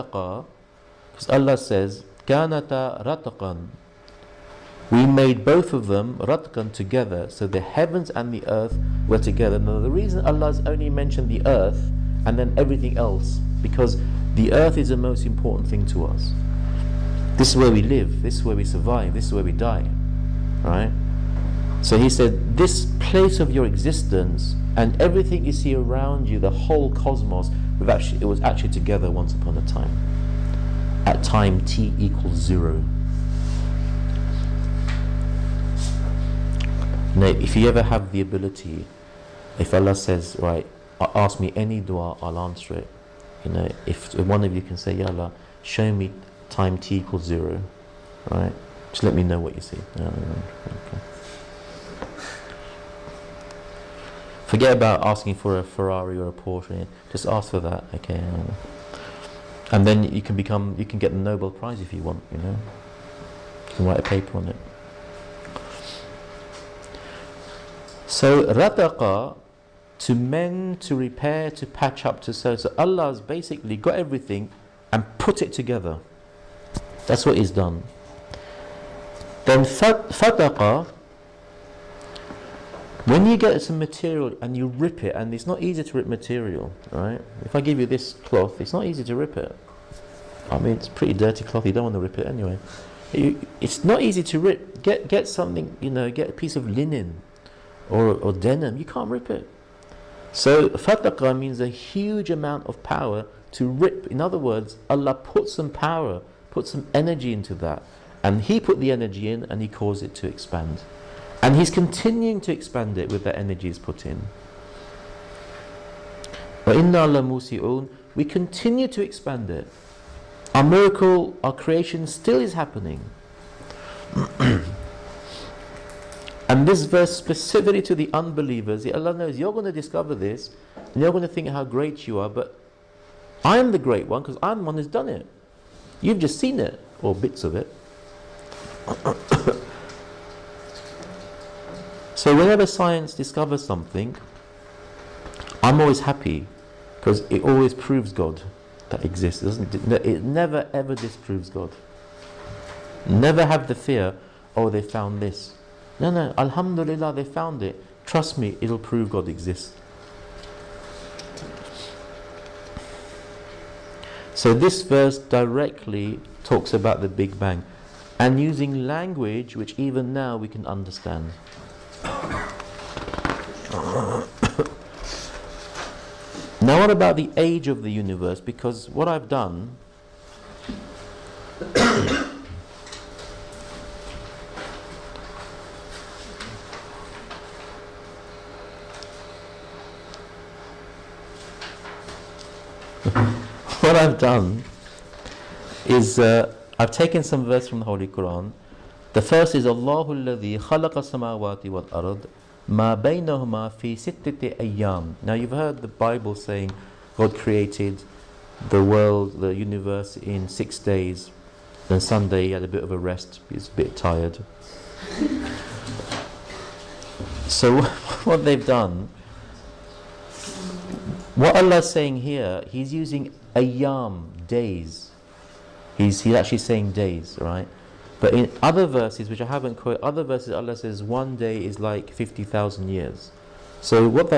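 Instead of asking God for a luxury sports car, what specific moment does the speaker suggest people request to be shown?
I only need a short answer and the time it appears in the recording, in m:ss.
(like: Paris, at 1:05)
time t equals 0, at 0:46.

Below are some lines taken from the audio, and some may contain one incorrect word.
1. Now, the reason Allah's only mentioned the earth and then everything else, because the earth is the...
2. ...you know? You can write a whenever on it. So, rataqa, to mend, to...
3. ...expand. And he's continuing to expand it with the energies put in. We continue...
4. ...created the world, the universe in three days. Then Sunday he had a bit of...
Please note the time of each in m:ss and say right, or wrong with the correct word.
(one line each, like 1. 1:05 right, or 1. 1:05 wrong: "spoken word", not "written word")
1. 0:09 right
2. 1:02 wrong: "paper", not "whenever"
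3. 1:50 right
4. 3:27 wrong: "six", not "three".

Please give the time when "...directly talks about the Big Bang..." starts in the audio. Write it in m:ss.
2:45.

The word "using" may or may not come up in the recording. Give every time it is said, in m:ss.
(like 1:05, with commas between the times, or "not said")
2:48, 3:42.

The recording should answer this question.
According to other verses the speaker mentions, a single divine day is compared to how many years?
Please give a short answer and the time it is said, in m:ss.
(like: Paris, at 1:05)
50,000, at 3:52.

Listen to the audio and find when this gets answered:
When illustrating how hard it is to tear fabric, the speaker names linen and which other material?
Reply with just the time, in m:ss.
1:38.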